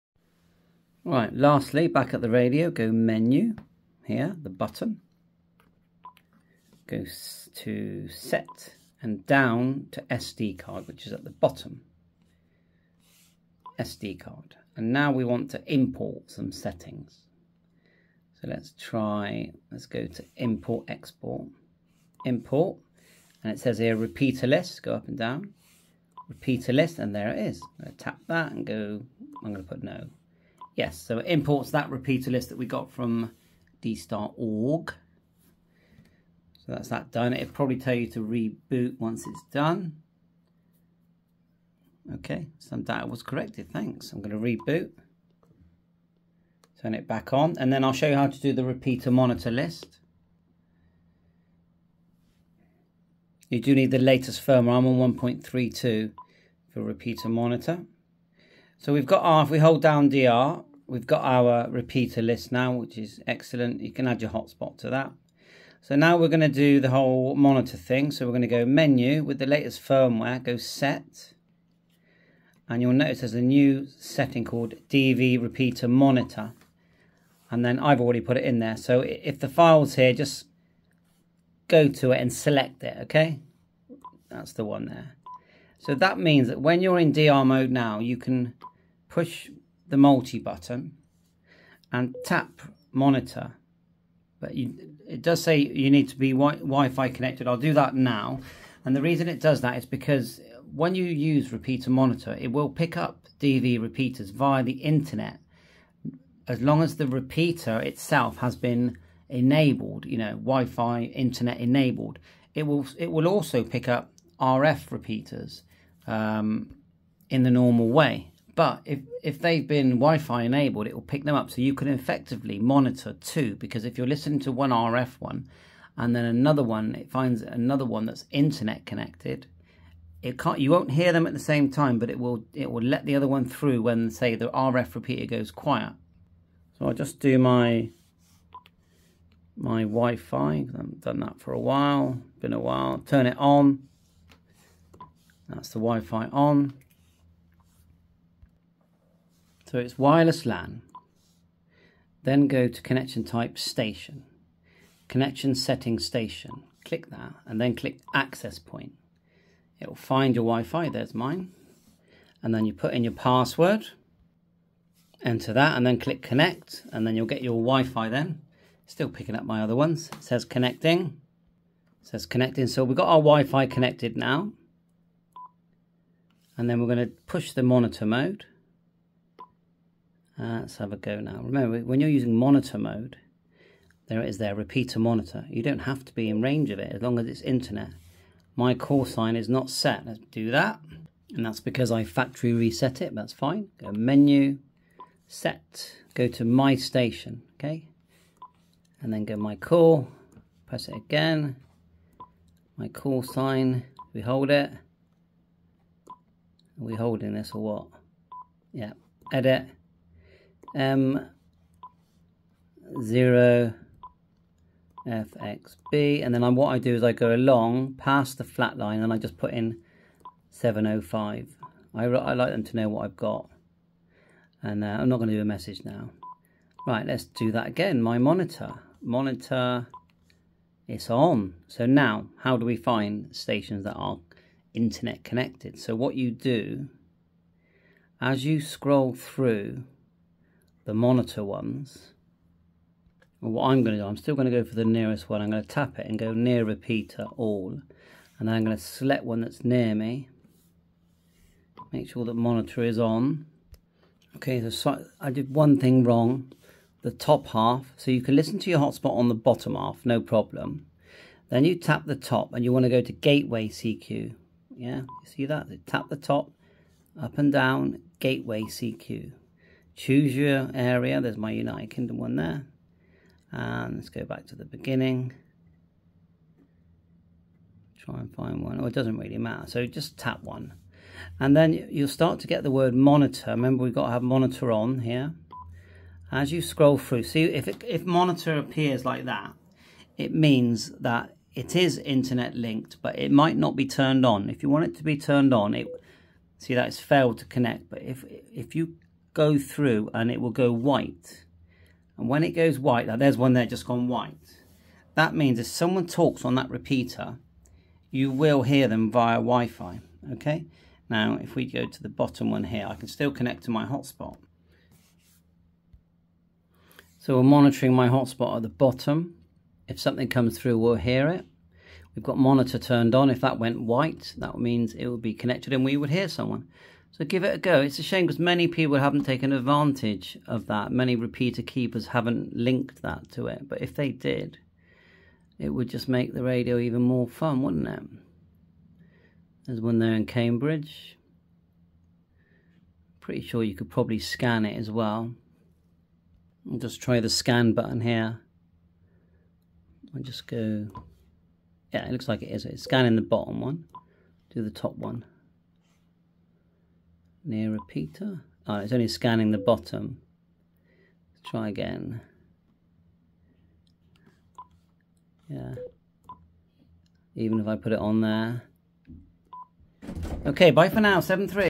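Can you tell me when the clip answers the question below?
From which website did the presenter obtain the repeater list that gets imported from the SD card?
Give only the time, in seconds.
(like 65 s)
33 s.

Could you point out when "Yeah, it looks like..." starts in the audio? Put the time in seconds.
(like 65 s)
351 s.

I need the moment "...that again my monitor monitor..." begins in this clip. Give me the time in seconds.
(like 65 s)
227 s.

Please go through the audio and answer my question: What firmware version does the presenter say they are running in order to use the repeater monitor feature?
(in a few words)
1.32.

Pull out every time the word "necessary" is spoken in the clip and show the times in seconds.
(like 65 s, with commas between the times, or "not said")
not said.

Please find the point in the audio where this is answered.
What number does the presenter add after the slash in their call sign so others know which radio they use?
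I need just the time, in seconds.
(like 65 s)
220 s.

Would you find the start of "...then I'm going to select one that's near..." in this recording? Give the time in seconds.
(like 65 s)
248 s.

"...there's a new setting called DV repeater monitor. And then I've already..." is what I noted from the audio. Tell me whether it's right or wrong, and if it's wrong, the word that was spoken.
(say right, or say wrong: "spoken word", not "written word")
right.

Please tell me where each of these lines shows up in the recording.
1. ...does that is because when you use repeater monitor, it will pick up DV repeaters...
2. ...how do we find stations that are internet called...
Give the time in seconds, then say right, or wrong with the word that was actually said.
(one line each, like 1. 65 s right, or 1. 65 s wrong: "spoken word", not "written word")
1. 99 s right
2. 232 s wrong: "connected", not "called".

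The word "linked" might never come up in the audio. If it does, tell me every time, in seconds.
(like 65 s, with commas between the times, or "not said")
292 s, 332 s.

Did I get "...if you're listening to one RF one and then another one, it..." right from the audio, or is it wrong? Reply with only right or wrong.
right.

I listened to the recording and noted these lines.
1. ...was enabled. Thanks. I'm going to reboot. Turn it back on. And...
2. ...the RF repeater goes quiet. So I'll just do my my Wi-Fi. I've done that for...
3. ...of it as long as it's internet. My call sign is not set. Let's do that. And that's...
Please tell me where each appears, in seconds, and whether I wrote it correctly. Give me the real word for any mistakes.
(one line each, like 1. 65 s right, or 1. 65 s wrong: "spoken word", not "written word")
1. 43 s wrong: "corrected", not "enabled"
2. 134 s right
3. 186 s right.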